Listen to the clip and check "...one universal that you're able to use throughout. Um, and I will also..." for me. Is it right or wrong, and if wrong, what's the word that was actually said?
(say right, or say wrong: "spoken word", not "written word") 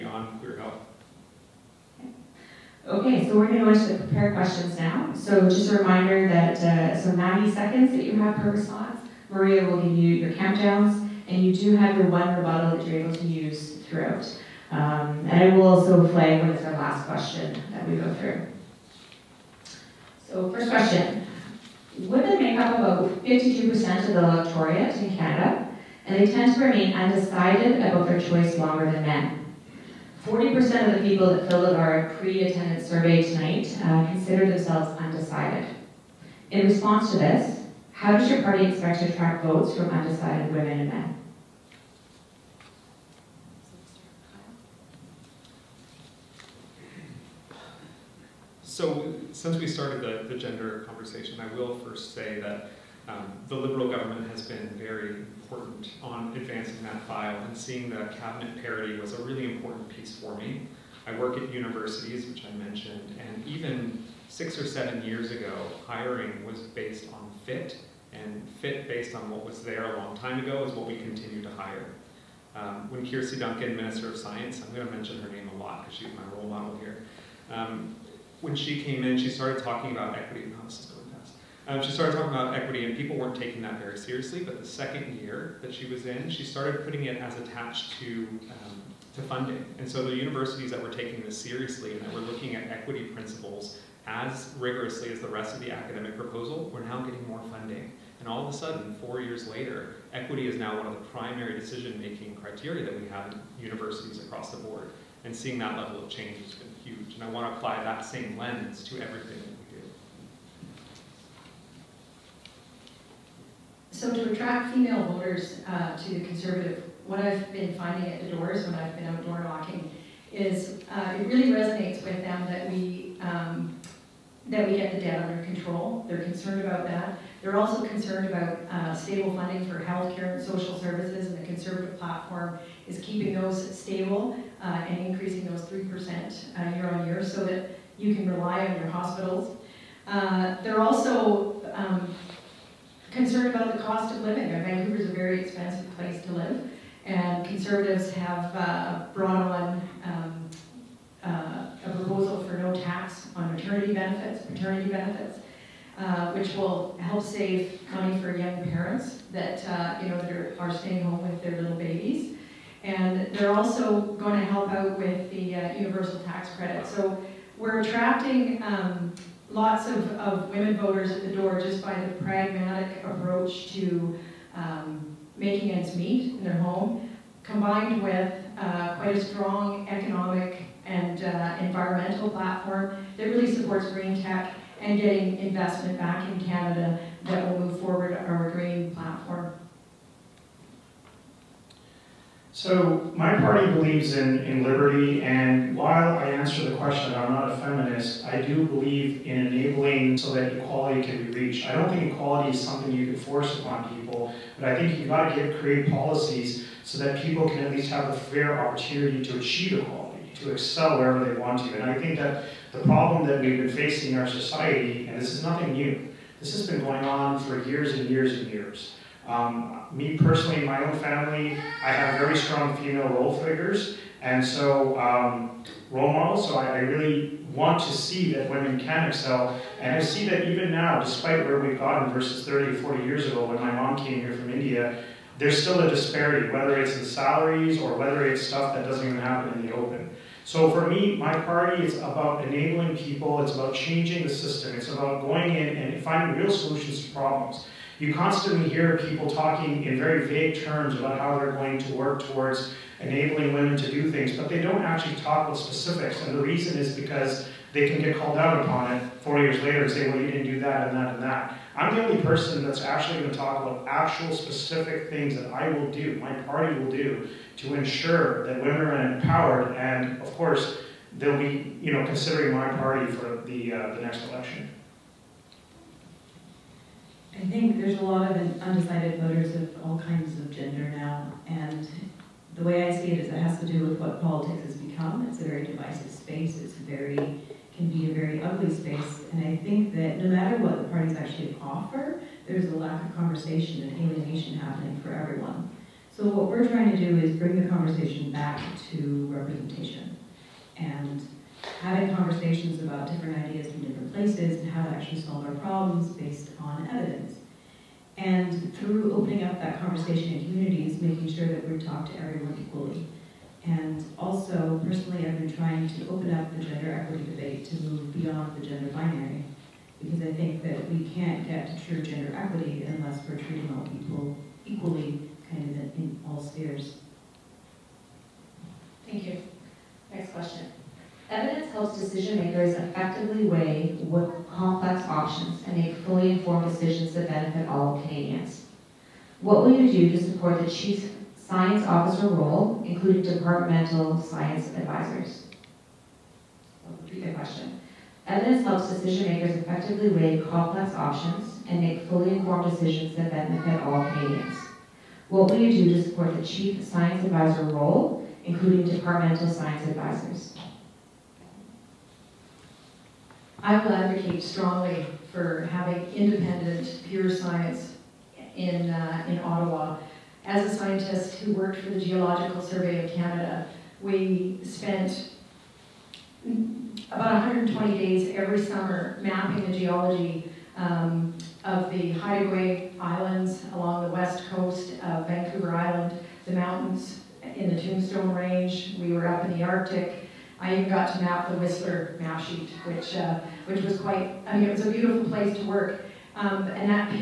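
wrong: "rebuttal", not "universal".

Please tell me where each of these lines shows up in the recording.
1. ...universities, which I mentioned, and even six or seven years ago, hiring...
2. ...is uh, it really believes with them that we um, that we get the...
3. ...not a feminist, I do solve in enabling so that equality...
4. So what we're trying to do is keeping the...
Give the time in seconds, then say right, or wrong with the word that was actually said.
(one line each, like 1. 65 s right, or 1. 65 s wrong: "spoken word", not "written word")
1. 61 s right
2. 120 s wrong: "resonates", not "believes"
3. 197 s wrong: "believe", not "solve"
4. 296 s wrong: "bring", not "keeping".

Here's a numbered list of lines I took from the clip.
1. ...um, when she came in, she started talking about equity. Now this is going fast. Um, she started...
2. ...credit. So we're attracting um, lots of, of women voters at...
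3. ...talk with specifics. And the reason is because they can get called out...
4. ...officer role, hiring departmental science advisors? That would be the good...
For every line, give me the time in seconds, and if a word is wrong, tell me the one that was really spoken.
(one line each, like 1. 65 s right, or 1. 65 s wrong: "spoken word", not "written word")
1. 77 s right
2. 166 s right
3. 255 s right
4. 341 s wrong: "including", not "hiring".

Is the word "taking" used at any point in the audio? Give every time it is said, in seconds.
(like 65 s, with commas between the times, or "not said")
83 s, 90 s.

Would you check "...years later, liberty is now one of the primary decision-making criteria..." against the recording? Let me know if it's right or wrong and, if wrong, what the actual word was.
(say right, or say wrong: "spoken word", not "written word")
wrong: "equity", not "liberty".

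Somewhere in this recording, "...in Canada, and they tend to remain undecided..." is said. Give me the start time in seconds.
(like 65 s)
24 s.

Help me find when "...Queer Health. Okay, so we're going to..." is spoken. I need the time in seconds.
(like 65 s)
0 s.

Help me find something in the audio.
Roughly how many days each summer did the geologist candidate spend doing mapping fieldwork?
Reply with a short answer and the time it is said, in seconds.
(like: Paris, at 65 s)
120, at 377 s.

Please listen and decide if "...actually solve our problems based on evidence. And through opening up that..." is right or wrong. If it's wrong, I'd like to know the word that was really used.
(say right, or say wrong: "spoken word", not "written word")
right.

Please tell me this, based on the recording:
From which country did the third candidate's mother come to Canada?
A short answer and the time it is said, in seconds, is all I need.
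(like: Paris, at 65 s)
India, at 234 s.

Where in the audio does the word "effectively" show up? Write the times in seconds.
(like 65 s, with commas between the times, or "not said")
332 s, 349 s.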